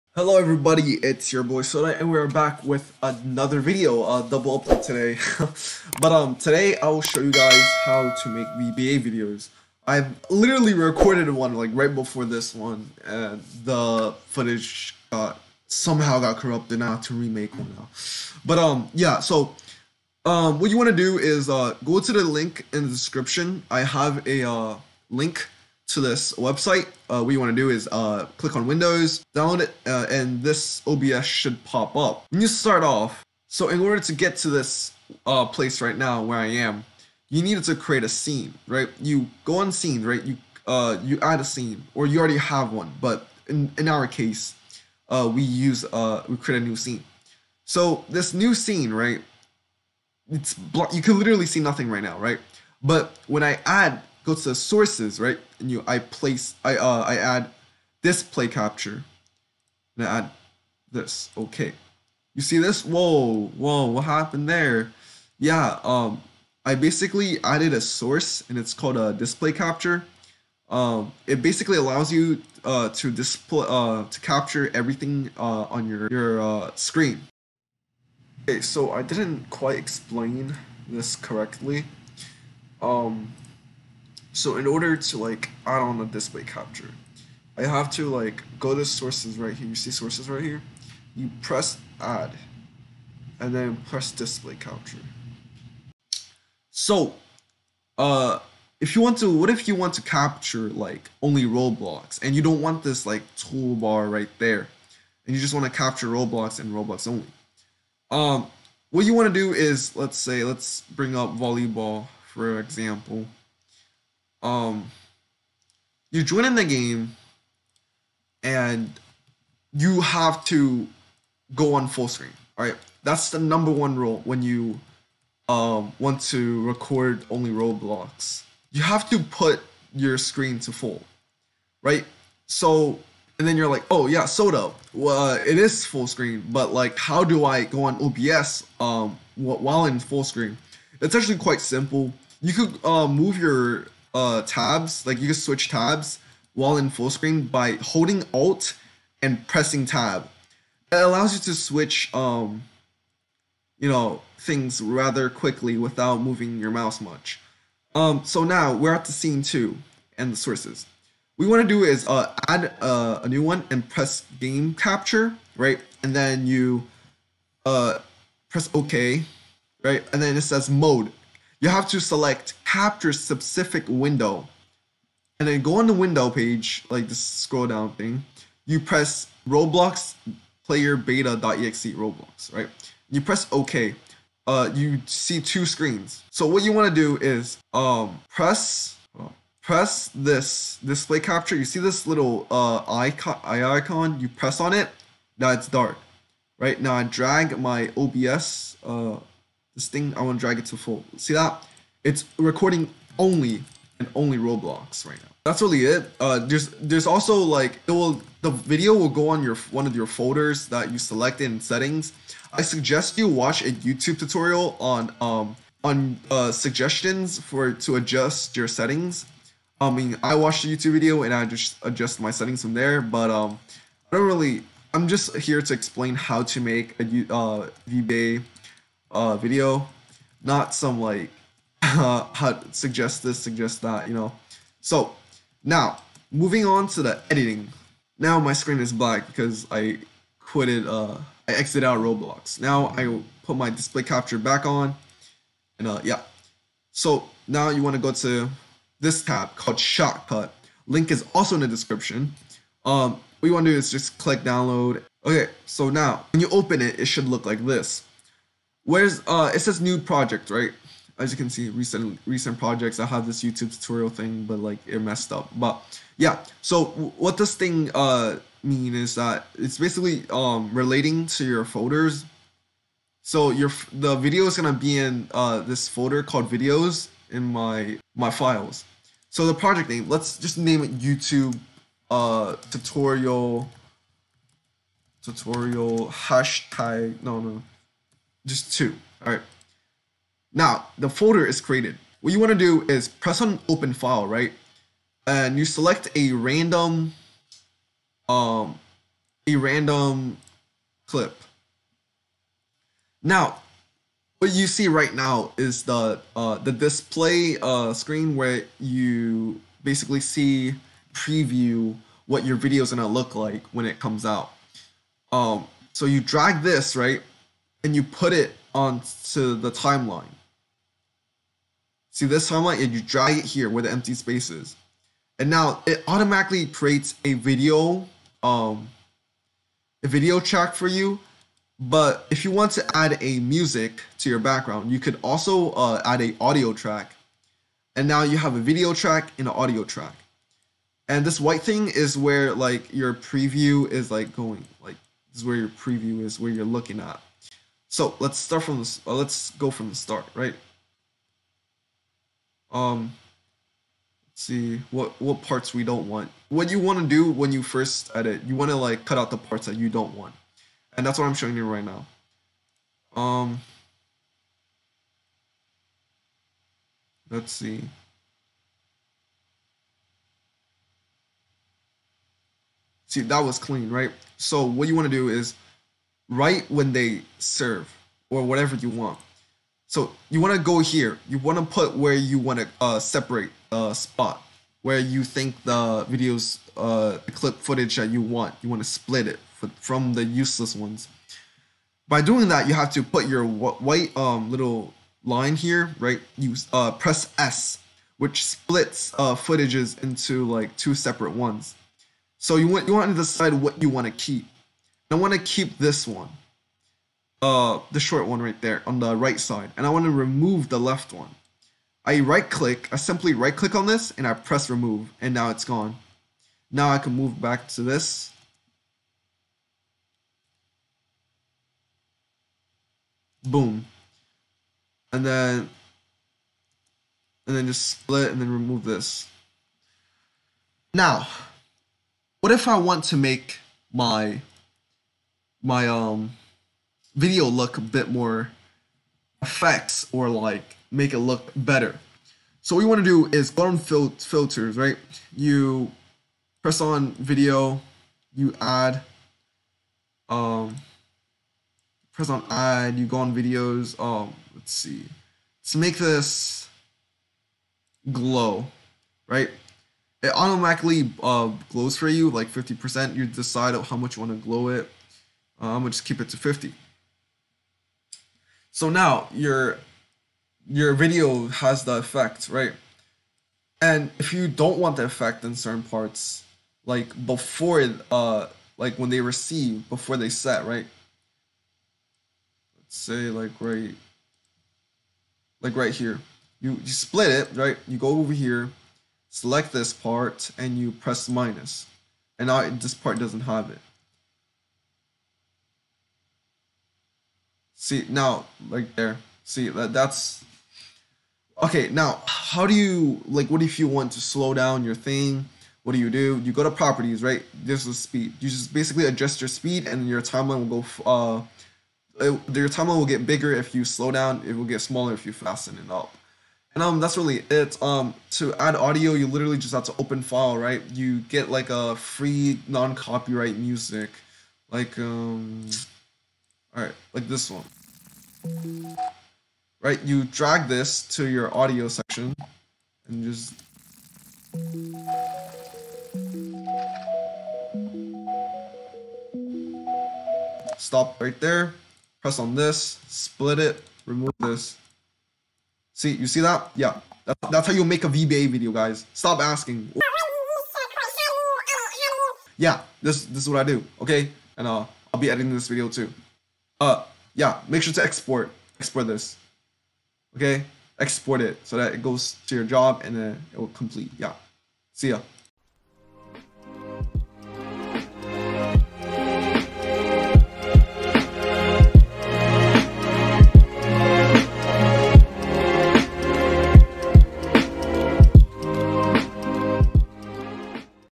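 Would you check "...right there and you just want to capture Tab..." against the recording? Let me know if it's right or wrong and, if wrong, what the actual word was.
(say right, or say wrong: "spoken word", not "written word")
wrong: "Roblox", not "Tab".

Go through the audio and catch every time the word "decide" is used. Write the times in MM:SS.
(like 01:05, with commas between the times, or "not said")
06:43, 07:43.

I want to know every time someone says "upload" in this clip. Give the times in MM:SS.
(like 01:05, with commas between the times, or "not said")
00:04.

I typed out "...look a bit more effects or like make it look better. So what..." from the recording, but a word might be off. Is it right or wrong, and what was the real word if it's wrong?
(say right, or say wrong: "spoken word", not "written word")
right.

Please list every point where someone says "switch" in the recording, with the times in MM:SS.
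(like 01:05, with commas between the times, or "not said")
02:25, 02:31.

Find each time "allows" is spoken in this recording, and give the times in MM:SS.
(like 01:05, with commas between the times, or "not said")
01:11, 02:30.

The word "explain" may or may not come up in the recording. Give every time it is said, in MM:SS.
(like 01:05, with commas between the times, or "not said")
01:19, 03:45.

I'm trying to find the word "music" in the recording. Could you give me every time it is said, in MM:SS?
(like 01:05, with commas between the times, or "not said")
05:33, 08:43.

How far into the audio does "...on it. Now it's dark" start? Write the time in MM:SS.
03:14.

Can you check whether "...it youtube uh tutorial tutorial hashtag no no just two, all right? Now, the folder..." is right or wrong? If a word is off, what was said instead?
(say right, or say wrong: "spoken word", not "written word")
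right.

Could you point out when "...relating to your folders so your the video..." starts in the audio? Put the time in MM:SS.
04:30.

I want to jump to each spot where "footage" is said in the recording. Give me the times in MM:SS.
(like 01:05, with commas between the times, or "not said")
00:14, 06:27, 06:39.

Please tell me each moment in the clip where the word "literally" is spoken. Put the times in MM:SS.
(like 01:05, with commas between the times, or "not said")
00:10, 00:51, 08:39.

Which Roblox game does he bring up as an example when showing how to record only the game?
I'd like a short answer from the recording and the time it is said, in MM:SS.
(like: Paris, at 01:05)
Volleyball, at 01:51.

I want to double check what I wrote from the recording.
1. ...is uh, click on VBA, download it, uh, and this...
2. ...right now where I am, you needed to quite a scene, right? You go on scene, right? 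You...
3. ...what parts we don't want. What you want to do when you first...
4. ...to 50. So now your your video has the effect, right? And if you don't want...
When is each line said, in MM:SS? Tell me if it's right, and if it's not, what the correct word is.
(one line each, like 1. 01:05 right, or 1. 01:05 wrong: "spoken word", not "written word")
1. 00:27 wrong: "Windows", not "VBA"
2. 00:35 wrong: "create", not "quite"
3. 05:55 right
4. 07:46 right.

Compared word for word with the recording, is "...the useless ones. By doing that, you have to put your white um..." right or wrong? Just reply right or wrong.
right.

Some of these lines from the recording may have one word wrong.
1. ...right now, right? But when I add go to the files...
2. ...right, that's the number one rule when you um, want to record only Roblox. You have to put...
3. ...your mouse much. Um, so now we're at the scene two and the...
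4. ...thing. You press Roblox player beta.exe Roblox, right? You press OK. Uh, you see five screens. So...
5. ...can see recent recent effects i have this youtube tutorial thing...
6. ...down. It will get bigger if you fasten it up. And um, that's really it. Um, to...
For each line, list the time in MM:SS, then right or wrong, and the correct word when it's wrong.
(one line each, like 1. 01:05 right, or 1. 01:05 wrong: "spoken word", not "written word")
1. 00:51 wrong: "sources", not "files"
2. 02:02 right
3. 02:36 right
4. 02:57 wrong: "two", not "five"
5. 04:21 wrong: "projects", not "effects"
6. 08:34 wrong: "smaller", not "bigger".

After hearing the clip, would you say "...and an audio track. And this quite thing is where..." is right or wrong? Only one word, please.
wrong.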